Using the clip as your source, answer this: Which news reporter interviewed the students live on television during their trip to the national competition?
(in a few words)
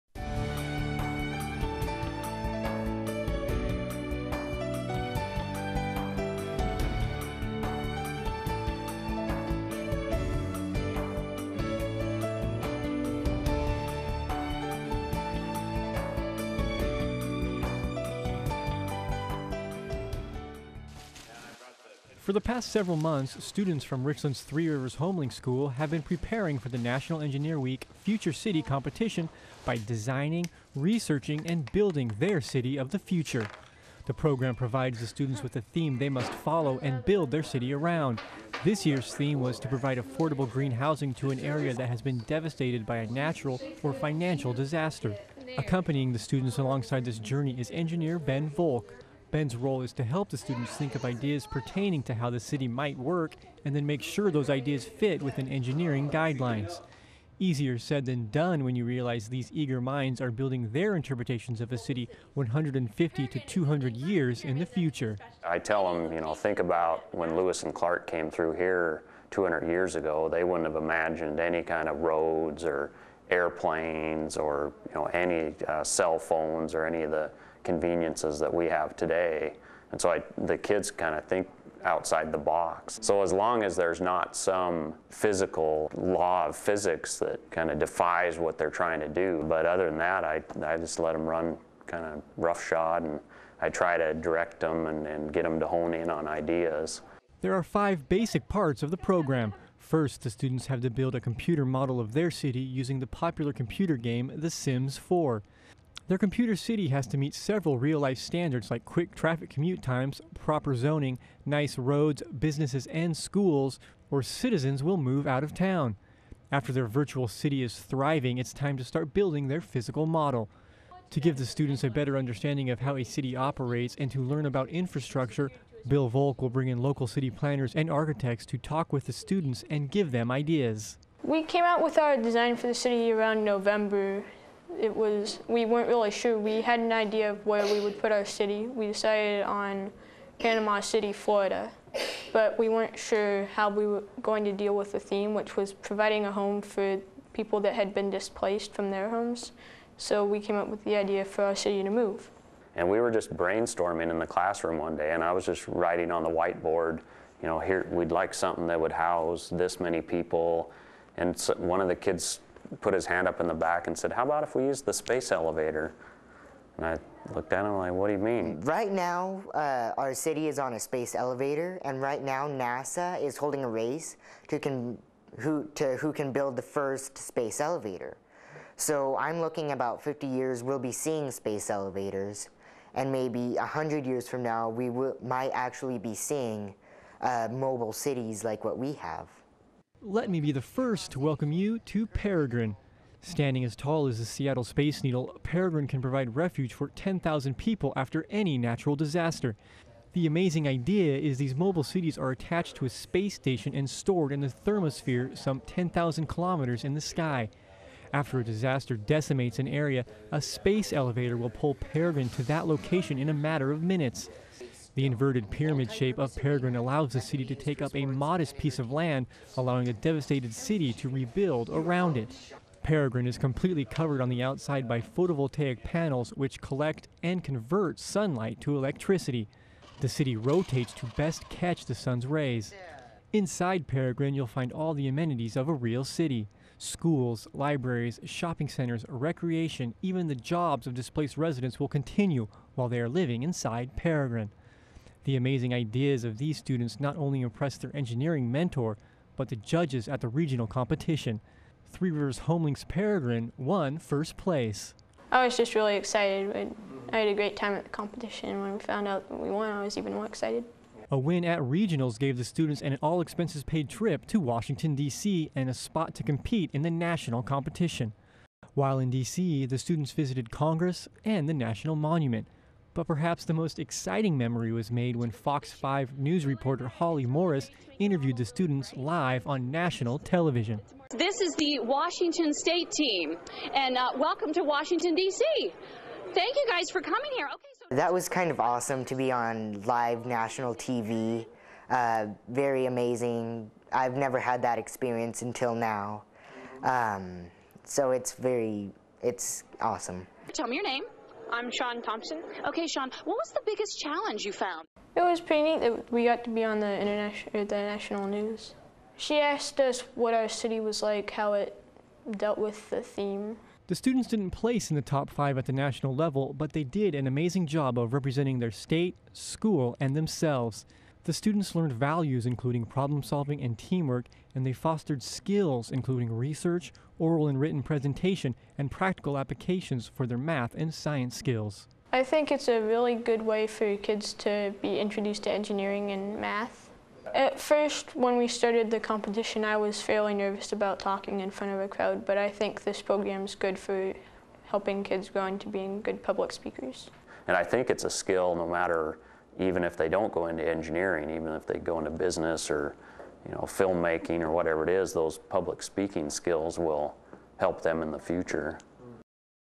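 Holly Morris.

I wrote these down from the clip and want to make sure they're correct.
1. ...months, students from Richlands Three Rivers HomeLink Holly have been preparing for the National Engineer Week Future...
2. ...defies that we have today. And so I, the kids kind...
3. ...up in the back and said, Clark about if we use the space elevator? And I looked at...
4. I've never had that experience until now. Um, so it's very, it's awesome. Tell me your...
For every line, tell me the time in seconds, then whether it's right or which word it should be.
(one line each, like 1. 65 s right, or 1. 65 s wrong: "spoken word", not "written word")
1. 22 s wrong: "School", not "Holly"
2. 77 s wrong: "conveniences", not "defies"
3. 163 s wrong: "How", not "Clark"
4. 293 s right.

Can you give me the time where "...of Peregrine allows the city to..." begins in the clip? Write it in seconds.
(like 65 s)
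216 s.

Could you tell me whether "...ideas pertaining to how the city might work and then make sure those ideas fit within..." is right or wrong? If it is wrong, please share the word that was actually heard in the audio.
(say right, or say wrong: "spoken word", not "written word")
right.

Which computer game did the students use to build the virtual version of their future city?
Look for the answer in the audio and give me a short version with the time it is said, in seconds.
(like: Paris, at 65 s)
The Sims 4, at 104 s.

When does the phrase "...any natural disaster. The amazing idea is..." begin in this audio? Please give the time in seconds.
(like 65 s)
198 s.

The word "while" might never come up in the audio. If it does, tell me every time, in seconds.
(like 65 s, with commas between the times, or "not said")
242 s, 268 s.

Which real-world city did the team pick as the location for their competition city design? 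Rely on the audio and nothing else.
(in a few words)
Panama City, Florida.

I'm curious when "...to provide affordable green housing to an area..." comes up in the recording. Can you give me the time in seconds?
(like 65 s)
39 s.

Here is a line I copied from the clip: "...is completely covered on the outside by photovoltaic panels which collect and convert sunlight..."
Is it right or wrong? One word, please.
right.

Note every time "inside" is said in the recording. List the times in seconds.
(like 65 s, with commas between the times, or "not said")
233 s, 243 s.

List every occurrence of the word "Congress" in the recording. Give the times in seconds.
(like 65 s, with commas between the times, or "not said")
270 s.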